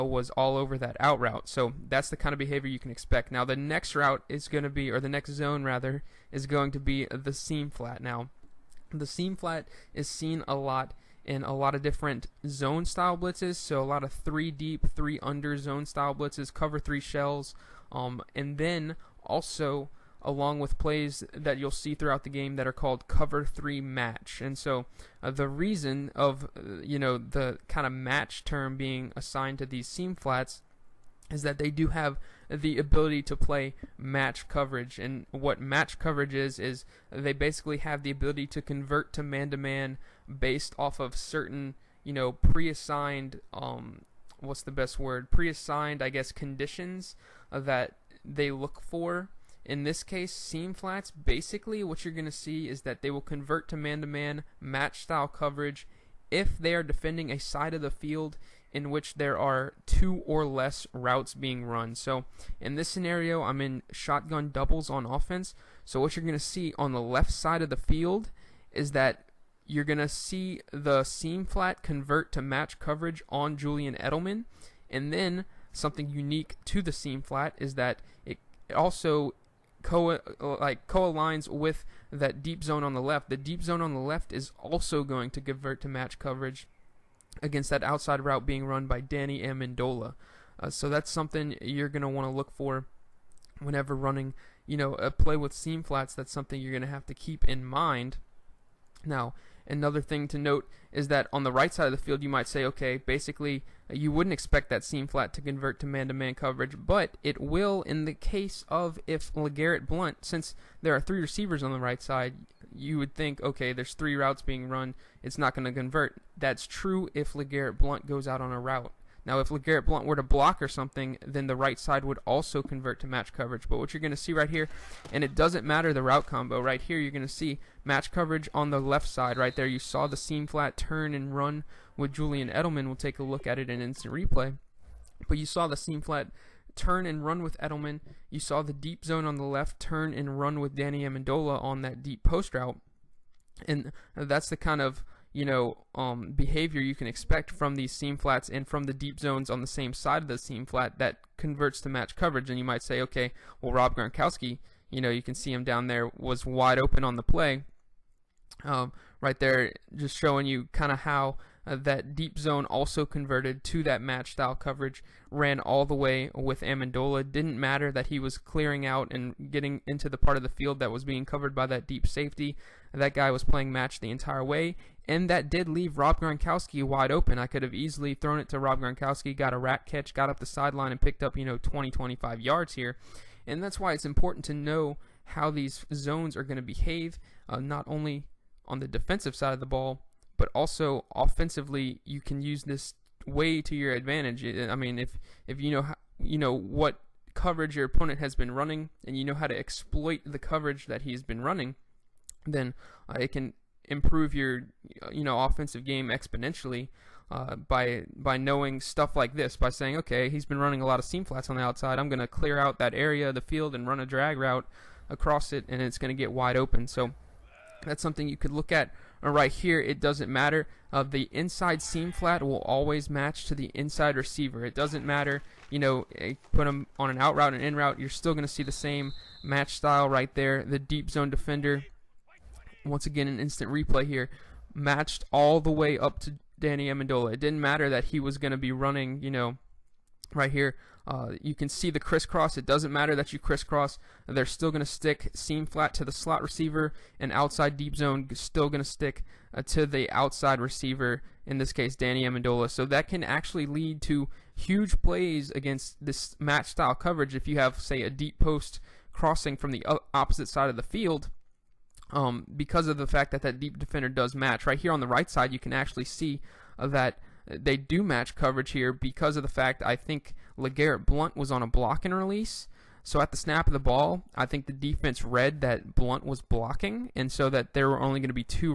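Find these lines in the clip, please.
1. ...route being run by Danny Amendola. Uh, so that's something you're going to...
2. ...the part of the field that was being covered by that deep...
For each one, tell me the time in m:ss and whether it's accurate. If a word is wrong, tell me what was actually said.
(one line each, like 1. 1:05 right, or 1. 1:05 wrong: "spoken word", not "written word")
1. 1:28 right
2. 2:50 right.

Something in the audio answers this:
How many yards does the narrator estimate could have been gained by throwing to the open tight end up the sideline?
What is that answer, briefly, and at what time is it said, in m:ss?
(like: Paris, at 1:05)
20 to 25 yards, at 3:01.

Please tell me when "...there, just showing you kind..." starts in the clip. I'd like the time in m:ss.
2:39.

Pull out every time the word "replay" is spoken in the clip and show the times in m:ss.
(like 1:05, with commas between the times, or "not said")
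2:14, 3:53.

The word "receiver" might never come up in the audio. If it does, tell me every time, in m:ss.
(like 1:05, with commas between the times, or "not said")
1:51, 3:44, 4:06, 4:10.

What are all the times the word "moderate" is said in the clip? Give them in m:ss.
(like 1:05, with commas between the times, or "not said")
not said.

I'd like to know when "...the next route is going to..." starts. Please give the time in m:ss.
0:03.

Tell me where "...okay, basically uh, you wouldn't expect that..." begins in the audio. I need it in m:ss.
1:42.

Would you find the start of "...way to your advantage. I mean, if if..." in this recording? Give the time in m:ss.
3:13.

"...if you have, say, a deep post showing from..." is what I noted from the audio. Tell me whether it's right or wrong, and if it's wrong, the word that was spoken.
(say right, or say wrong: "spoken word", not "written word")
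wrong: "crossing", not "showing".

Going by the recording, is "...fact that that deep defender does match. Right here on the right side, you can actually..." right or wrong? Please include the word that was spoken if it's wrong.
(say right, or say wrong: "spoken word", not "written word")
right.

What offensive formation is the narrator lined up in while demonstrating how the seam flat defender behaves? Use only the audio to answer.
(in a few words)
Shotgun doubles.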